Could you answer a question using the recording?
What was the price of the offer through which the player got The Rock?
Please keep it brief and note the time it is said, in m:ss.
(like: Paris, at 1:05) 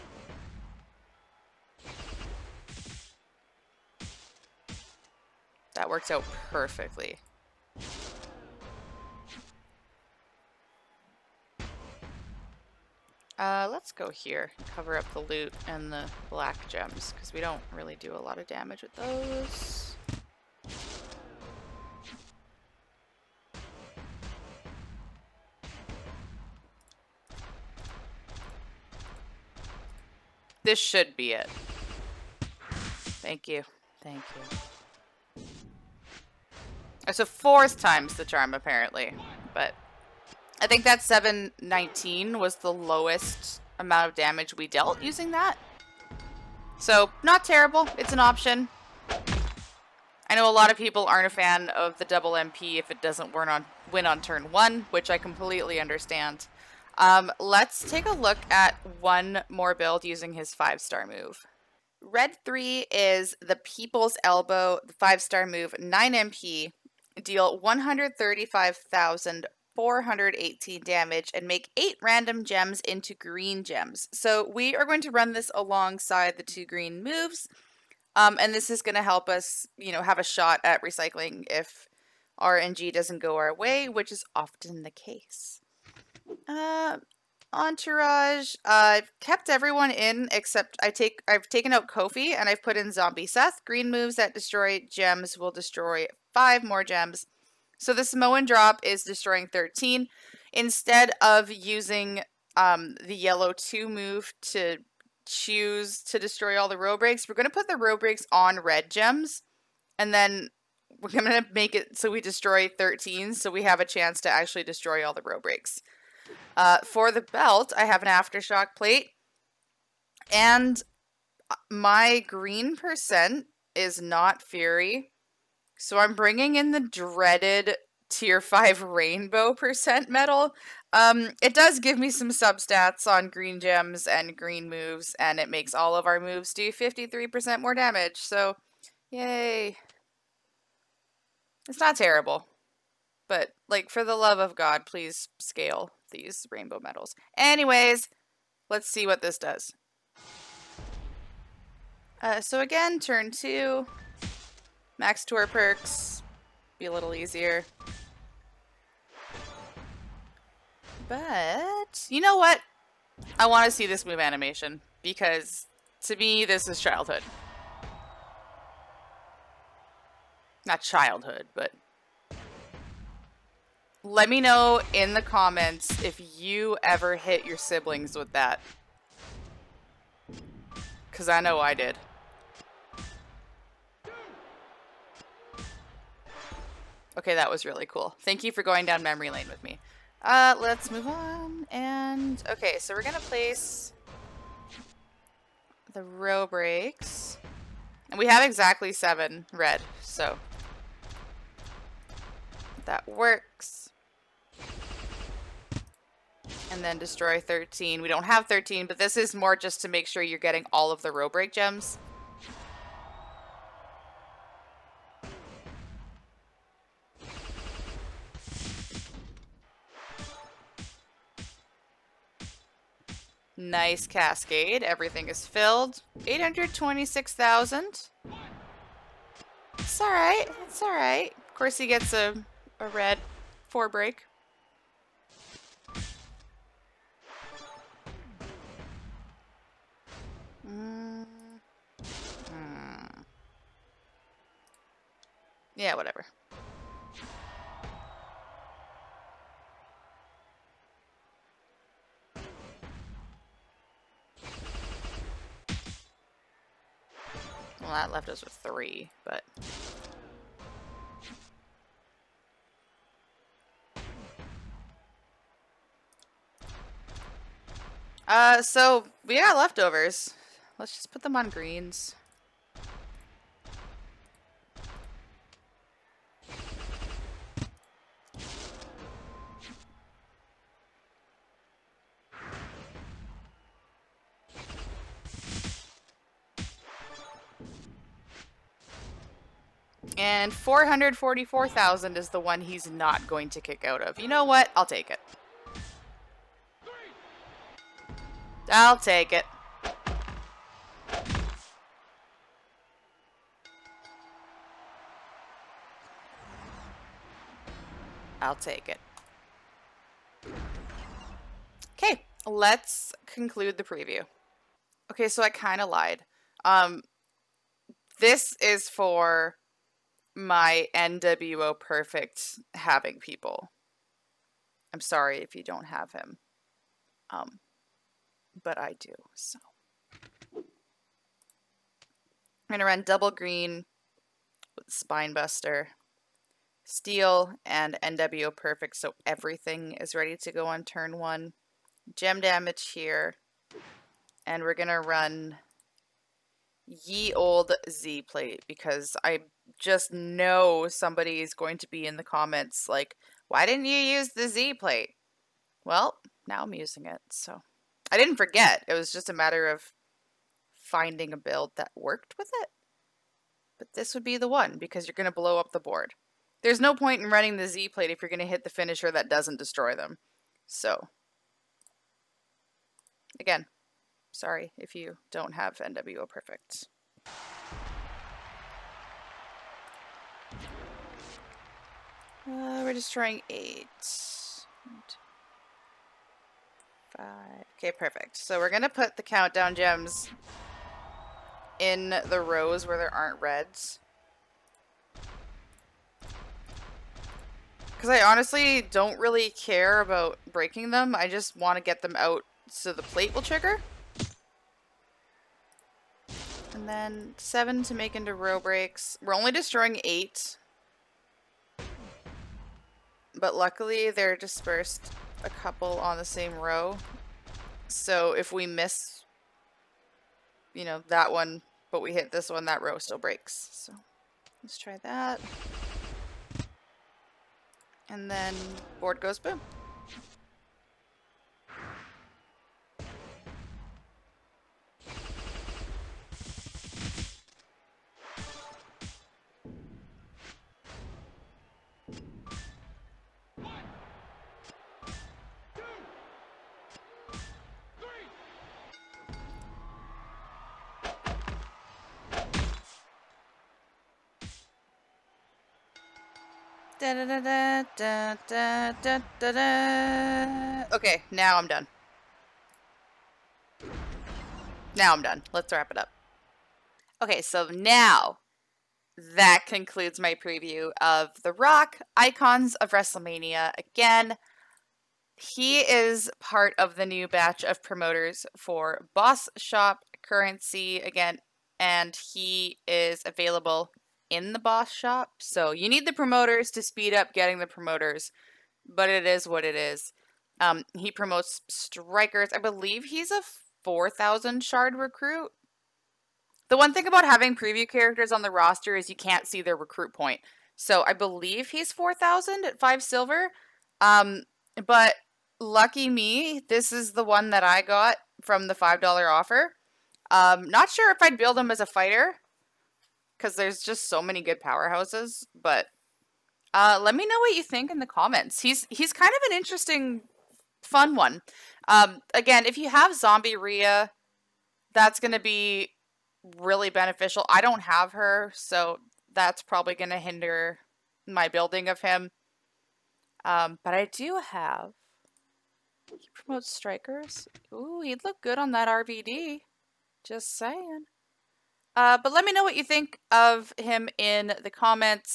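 $5, at 8:28.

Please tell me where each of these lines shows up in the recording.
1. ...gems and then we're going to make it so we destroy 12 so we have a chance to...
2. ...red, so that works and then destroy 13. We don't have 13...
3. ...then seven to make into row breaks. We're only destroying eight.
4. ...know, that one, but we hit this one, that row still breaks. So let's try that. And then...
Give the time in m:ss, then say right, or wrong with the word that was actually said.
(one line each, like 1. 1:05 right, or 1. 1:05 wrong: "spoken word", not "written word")
1. 1:48 wrong: "13", not "12"
2. 3:19 right
3. 6:46 right
4. 7:00 right.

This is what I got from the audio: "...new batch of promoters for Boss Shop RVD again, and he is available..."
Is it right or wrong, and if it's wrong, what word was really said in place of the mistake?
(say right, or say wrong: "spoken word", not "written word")
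wrong: "Currency", not "RVD".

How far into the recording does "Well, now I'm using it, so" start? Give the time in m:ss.
5:55.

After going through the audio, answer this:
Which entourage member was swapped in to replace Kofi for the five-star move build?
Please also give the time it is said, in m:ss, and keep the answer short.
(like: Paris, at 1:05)
Zombie Seth, at 1:32.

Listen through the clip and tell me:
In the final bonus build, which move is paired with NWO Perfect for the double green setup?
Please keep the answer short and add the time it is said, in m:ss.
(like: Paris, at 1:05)
Spinebuster, at 5:34.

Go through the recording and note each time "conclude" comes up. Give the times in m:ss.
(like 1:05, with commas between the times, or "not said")
5:13, 7:49.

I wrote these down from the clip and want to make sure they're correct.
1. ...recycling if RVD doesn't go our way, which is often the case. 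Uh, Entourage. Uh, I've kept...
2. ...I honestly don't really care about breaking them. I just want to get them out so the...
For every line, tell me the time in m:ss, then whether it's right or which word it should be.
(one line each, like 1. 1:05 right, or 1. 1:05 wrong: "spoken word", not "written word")
1. 1:20 wrong: "RNG", not "RVD"
2. 6:38 right.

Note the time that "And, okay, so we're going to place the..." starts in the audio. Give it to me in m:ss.
3:11.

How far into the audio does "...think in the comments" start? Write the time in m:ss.
8:37.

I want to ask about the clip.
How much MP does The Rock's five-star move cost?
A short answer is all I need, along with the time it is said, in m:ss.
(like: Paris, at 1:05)
9, at 1:05.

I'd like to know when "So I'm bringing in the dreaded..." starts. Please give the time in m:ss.
2:05.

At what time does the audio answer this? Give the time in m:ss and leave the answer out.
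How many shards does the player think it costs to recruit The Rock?
8:13.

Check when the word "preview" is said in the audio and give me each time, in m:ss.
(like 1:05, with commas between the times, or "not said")
5:13, 7:50, 8:17.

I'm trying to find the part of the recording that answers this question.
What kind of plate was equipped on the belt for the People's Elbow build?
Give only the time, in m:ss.
1:58.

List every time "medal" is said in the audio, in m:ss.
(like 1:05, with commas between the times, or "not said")
2:10, 2:26.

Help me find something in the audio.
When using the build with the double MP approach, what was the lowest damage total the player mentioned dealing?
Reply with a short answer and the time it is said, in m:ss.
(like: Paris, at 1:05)
719, at 0:41.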